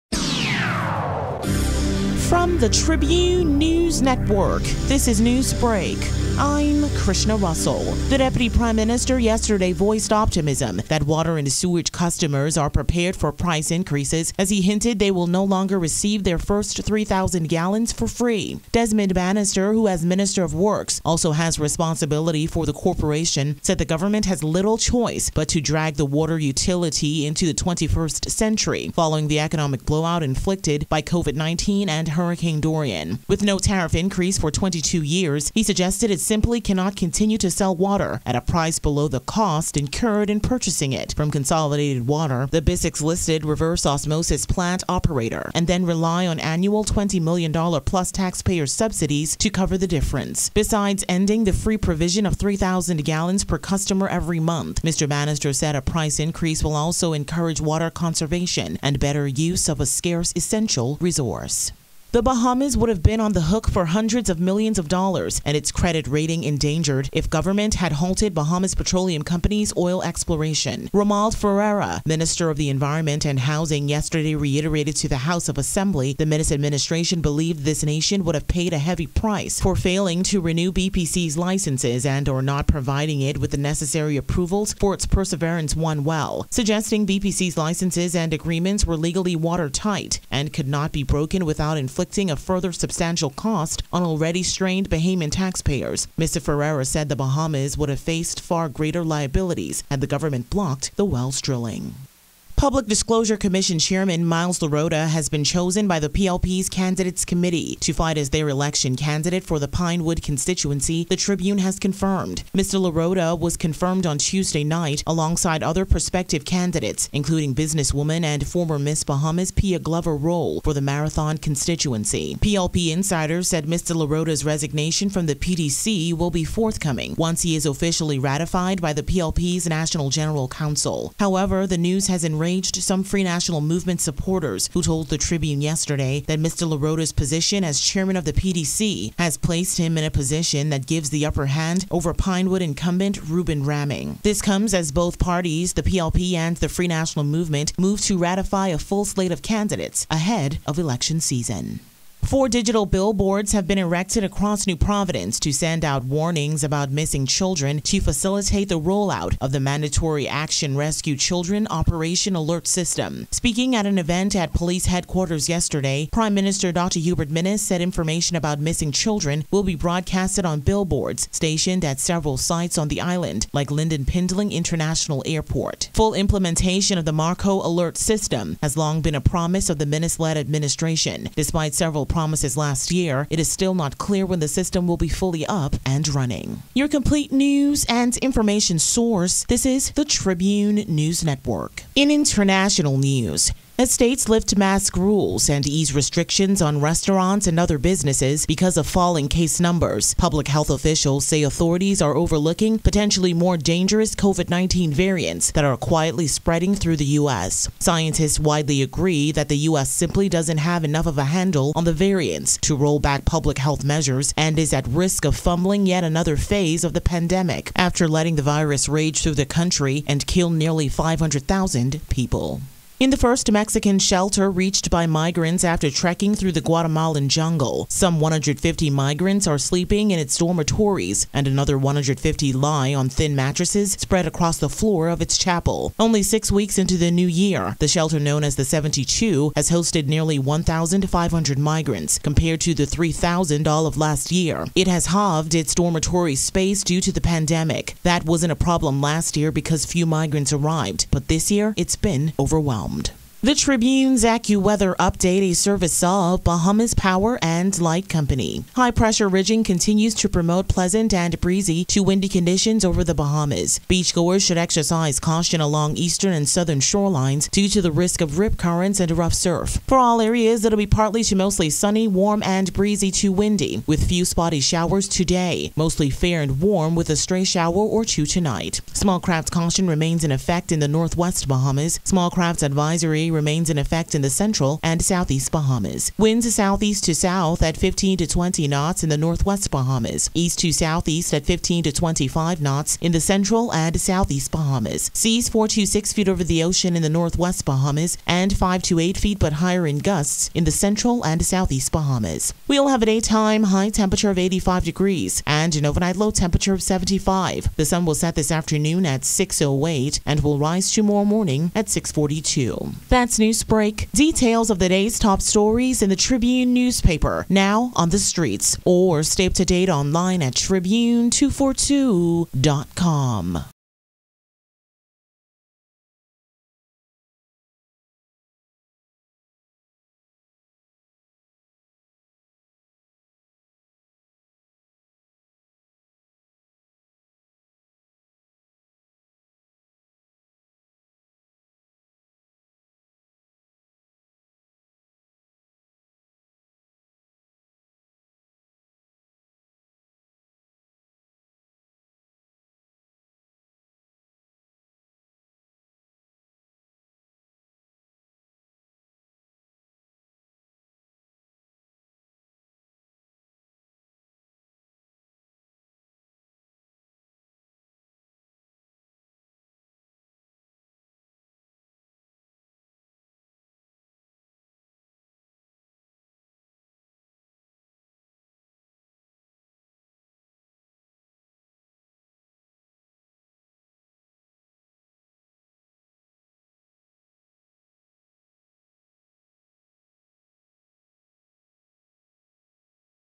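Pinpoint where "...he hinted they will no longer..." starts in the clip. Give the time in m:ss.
0:14.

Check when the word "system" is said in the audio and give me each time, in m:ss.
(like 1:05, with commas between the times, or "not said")
2:42, 2:57, 3:04.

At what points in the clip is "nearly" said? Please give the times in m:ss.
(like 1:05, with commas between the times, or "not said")
3:40, 4:00.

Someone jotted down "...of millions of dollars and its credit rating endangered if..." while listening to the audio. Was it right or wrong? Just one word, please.
right.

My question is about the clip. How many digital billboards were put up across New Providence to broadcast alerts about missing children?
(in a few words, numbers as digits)
4.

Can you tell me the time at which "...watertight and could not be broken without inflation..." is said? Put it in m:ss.
1:29.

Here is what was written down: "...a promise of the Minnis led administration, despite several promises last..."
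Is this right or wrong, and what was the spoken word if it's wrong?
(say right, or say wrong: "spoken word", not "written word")
right.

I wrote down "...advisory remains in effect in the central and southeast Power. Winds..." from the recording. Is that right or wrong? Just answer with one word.
wrong.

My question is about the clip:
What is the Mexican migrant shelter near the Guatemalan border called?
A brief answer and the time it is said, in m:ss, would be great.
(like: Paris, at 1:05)
the 72, at 3:58.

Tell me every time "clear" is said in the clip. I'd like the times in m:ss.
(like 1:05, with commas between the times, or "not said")
3:03.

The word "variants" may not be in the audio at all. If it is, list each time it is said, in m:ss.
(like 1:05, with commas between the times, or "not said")
3:24, 3:31.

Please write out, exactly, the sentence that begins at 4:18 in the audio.
High pressure ridging continues to promote pleasant and breezy to windy conditions over the Bahamas.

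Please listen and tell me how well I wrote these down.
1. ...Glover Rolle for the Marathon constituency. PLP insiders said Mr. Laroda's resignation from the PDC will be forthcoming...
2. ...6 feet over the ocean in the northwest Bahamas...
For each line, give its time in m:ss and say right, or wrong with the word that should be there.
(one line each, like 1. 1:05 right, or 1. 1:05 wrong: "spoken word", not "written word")
1. 1:59 right
2. 4:55 right.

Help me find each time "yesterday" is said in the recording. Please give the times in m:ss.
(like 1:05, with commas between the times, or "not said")
0:09, 1:13, 2:15, 2:45.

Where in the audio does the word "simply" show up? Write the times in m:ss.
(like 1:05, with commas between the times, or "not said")
0:36, 3:29.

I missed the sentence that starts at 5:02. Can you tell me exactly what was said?
We'll have a daytime high temperature of 85 degrees and an overnight low temperature of 75.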